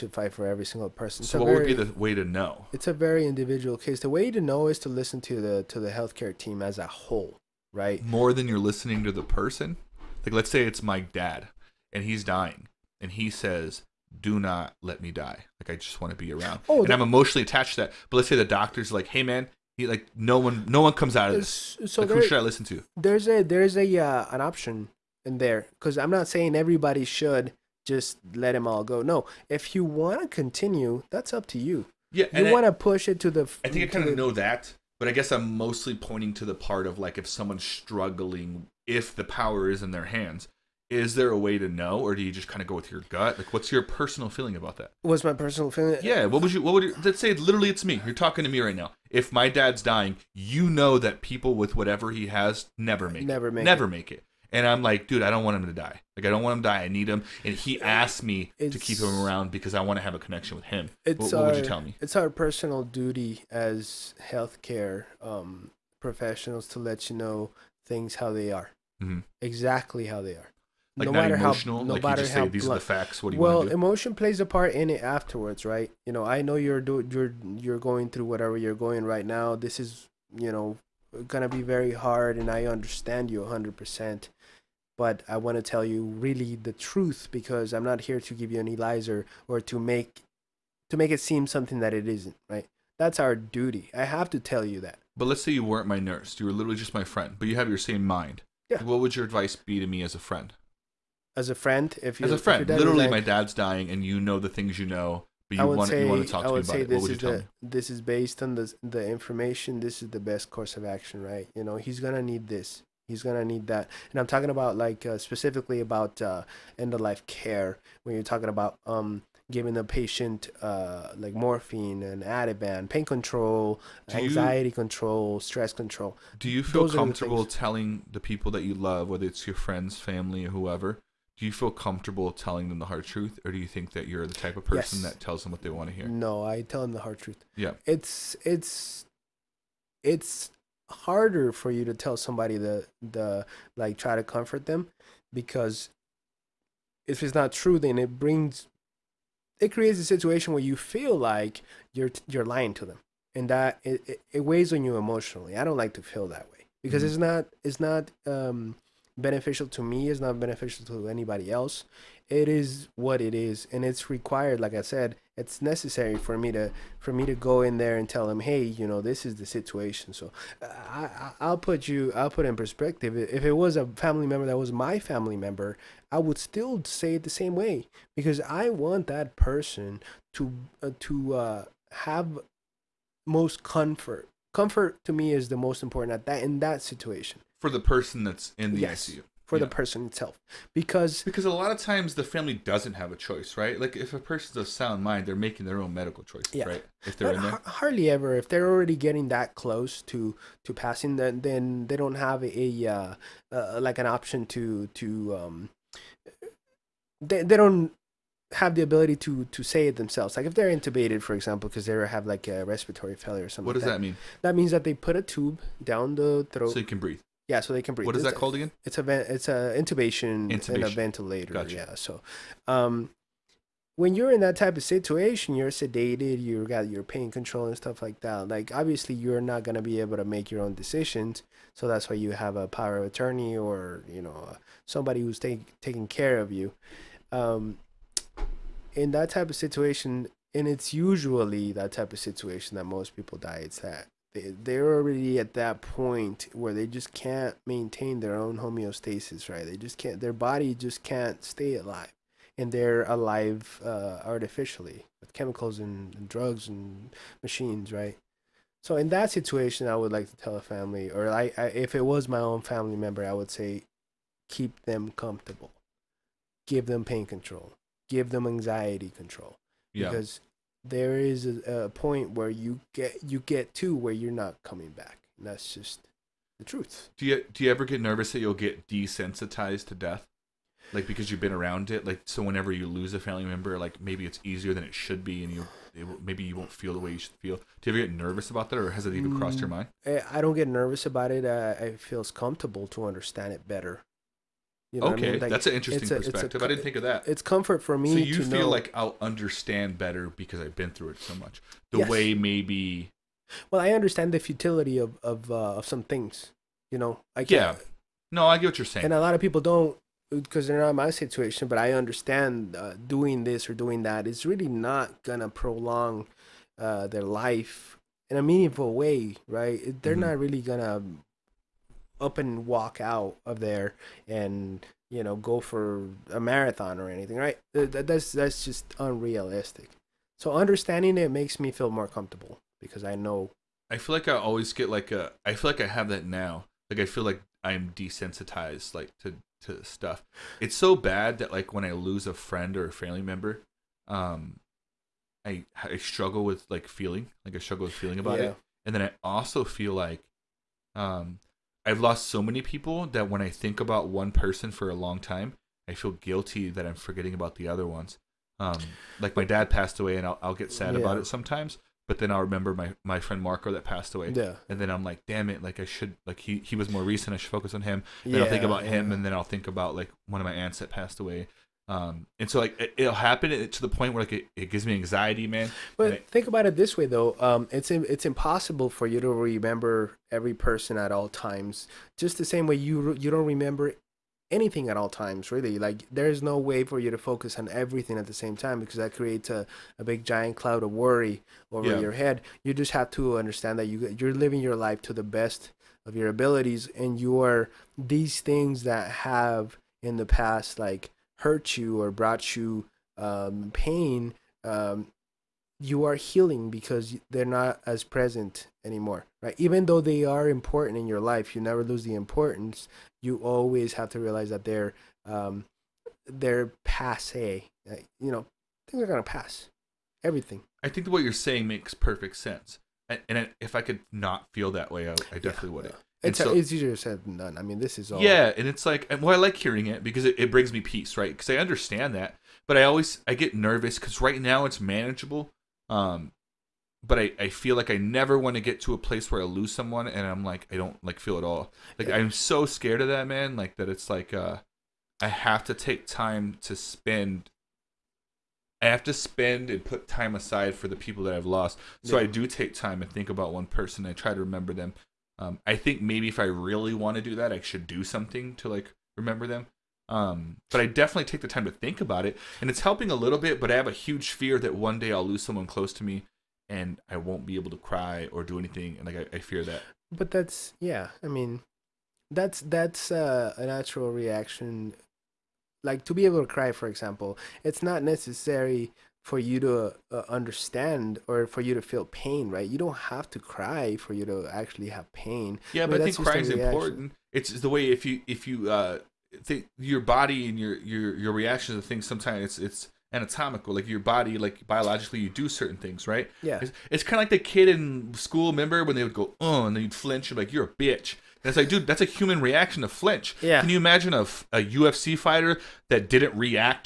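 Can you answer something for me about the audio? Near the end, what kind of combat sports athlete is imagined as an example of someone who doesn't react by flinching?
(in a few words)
UFC fighter.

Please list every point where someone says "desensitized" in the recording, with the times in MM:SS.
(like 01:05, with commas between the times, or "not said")
04:38, 05:37.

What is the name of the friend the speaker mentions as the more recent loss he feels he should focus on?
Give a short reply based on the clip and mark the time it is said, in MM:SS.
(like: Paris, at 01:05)
Marco, at 06:03.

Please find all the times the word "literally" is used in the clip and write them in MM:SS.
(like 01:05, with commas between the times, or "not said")
00:47, 01:36, 01:42.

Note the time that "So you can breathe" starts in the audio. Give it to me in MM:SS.
03:36.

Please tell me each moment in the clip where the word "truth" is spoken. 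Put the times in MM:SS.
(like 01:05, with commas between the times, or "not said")
01:26, 02:13, 02:17, 04:36.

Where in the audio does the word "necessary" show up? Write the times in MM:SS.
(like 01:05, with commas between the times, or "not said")
02:45, 07:58.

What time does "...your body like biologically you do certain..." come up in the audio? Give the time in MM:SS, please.
08:13.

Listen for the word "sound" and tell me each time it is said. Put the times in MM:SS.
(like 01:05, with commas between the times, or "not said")
03:14.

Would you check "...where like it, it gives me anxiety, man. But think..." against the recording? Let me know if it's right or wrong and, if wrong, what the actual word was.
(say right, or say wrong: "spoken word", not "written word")
right.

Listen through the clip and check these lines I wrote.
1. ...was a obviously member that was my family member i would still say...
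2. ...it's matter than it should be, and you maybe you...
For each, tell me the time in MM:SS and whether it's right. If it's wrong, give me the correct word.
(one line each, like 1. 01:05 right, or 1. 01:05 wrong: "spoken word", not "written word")
1. 02:53 wrong: "family", not "obviously"
2. 04:44 wrong: "easier", not "matter".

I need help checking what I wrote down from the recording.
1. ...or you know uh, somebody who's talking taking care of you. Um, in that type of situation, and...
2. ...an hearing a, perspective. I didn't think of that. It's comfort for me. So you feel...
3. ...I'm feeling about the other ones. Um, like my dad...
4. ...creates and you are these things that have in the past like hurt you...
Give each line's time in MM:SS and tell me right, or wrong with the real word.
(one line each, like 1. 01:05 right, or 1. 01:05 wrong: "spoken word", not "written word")
1. 03:53 wrong: "taking", not "talking"
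2. 04:55 wrong: "interesting", not "hearing"
3. 05:56 wrong: "forgetting", not "feeling"
4. 06:36 wrong: "abilities", not "creates".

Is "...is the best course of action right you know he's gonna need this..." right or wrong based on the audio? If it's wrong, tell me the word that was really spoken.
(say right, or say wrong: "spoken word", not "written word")
right.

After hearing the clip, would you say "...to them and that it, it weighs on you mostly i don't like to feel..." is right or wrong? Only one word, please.
wrong.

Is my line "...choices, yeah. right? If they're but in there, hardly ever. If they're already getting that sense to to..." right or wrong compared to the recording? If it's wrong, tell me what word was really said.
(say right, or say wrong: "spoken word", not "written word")
wrong: "close", not "sense".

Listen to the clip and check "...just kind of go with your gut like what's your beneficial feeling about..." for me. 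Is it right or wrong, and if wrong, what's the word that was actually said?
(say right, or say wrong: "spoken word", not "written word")
wrong: "personal", not "beneficial".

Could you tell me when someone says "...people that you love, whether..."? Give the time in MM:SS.
02:08.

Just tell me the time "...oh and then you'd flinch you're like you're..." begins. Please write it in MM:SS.
08:19.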